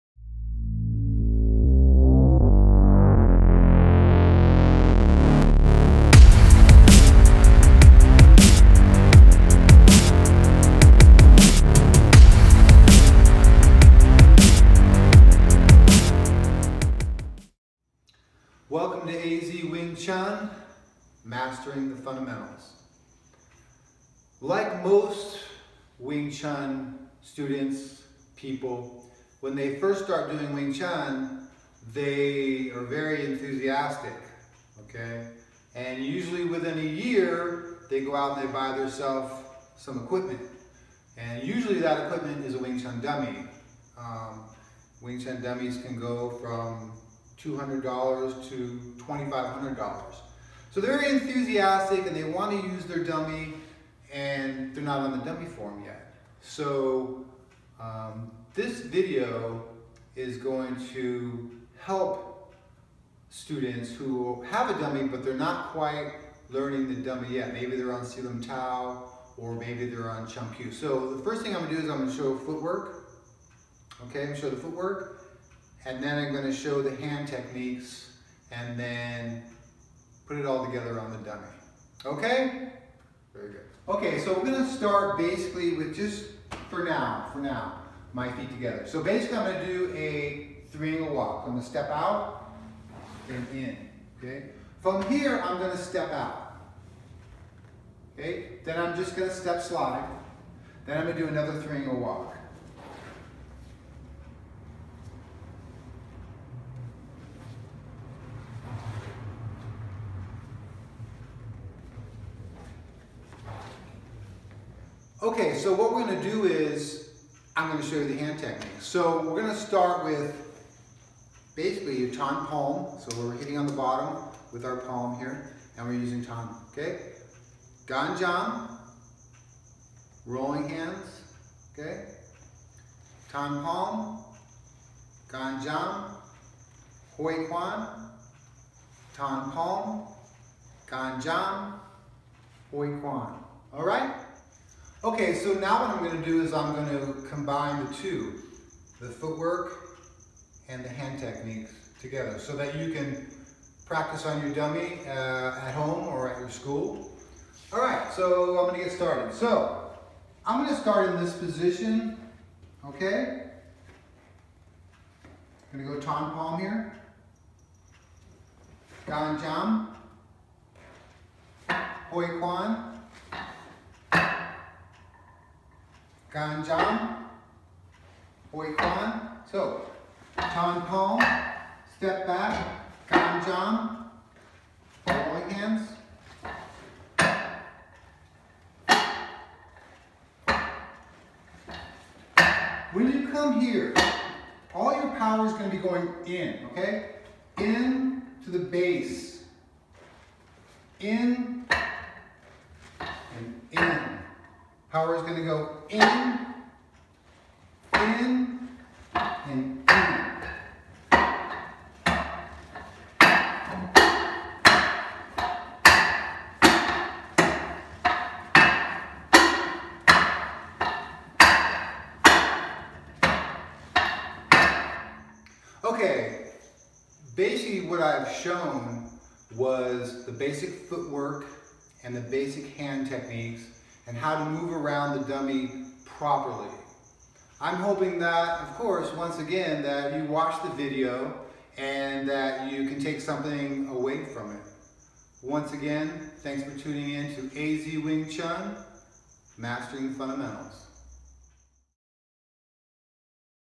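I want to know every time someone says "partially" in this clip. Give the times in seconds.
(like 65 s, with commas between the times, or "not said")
not said.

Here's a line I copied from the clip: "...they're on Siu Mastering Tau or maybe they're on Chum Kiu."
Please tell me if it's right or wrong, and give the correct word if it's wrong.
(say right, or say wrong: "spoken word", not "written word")
wrong: "Lim", not "Mastering".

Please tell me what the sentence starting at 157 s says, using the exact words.
All right, so I'm going to get started.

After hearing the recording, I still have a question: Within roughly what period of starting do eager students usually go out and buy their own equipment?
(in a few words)
a year.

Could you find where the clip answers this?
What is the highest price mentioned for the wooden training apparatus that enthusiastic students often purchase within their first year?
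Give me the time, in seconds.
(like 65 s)
48 s.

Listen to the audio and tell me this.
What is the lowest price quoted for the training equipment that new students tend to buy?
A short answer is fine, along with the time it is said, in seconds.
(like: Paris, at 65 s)
$200, at 47 s.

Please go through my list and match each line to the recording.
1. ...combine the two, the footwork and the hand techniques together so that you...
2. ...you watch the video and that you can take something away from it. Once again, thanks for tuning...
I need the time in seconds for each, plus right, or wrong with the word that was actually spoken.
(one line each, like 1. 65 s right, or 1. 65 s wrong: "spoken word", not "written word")
1. 147 s right
2. 240 s right.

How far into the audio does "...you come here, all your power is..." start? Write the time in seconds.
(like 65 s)
193 s.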